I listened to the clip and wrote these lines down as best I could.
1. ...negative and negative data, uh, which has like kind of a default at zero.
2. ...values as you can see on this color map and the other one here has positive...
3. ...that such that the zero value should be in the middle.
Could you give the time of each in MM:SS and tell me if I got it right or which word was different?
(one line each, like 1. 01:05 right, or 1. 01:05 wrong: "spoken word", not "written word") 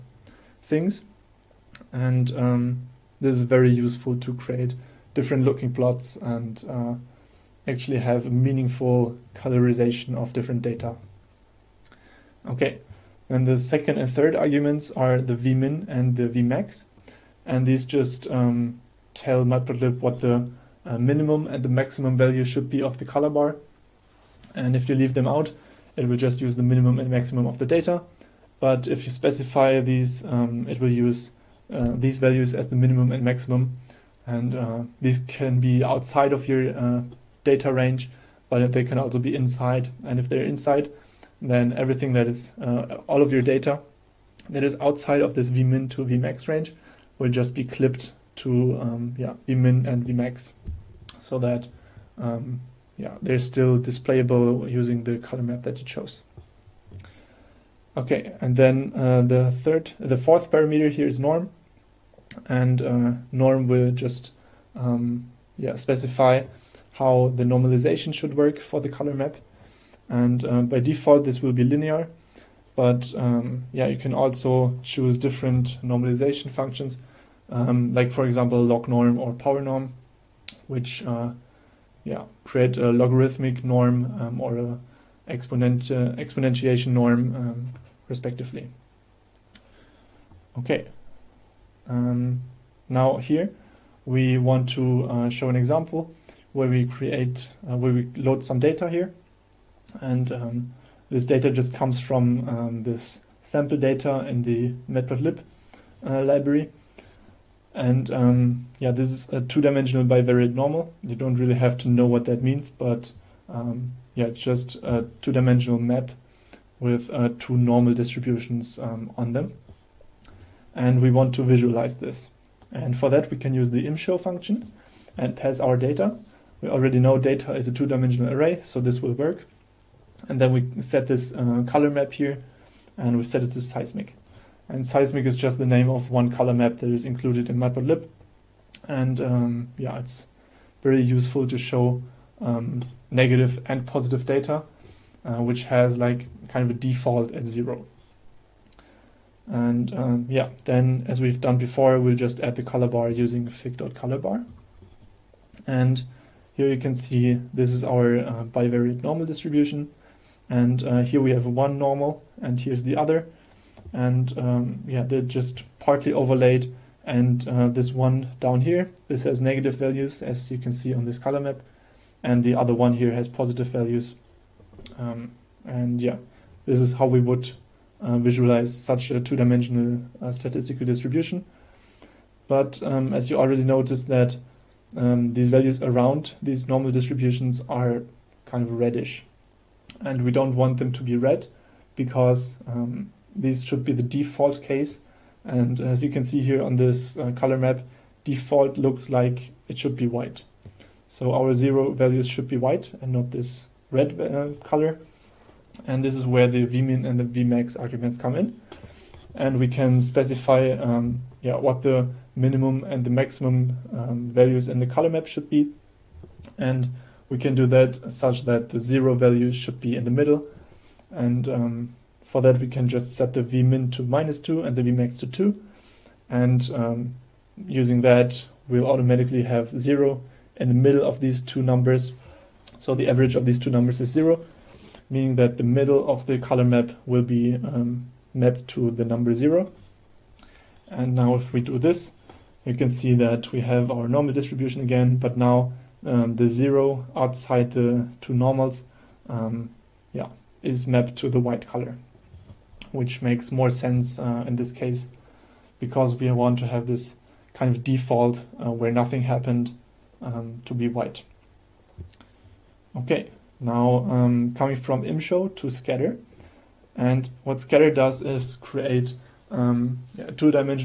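1. 02:23 wrong: "positive", not "negative"
2. 02:49 right
3. 03:37 right.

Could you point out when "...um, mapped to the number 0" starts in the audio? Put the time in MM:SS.
03:57.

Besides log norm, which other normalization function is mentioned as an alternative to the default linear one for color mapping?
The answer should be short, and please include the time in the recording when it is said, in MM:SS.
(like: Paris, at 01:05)
power norm, at 01:19.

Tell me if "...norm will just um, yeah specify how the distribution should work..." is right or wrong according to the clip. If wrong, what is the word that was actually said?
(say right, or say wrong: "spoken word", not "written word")
wrong: "normalization", not "distribution".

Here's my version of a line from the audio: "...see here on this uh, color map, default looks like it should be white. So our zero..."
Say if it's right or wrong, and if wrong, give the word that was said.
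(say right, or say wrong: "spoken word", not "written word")
right.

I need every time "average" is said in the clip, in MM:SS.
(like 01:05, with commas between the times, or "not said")
03:53.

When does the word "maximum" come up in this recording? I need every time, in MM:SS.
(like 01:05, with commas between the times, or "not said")
00:21, 00:27, 00:33, 03:33.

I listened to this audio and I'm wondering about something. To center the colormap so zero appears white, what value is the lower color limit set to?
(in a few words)
-2.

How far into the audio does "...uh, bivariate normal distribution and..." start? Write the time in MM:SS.
02:38.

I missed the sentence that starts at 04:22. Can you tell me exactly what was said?
Okay, now um, coming from imshow to scatter.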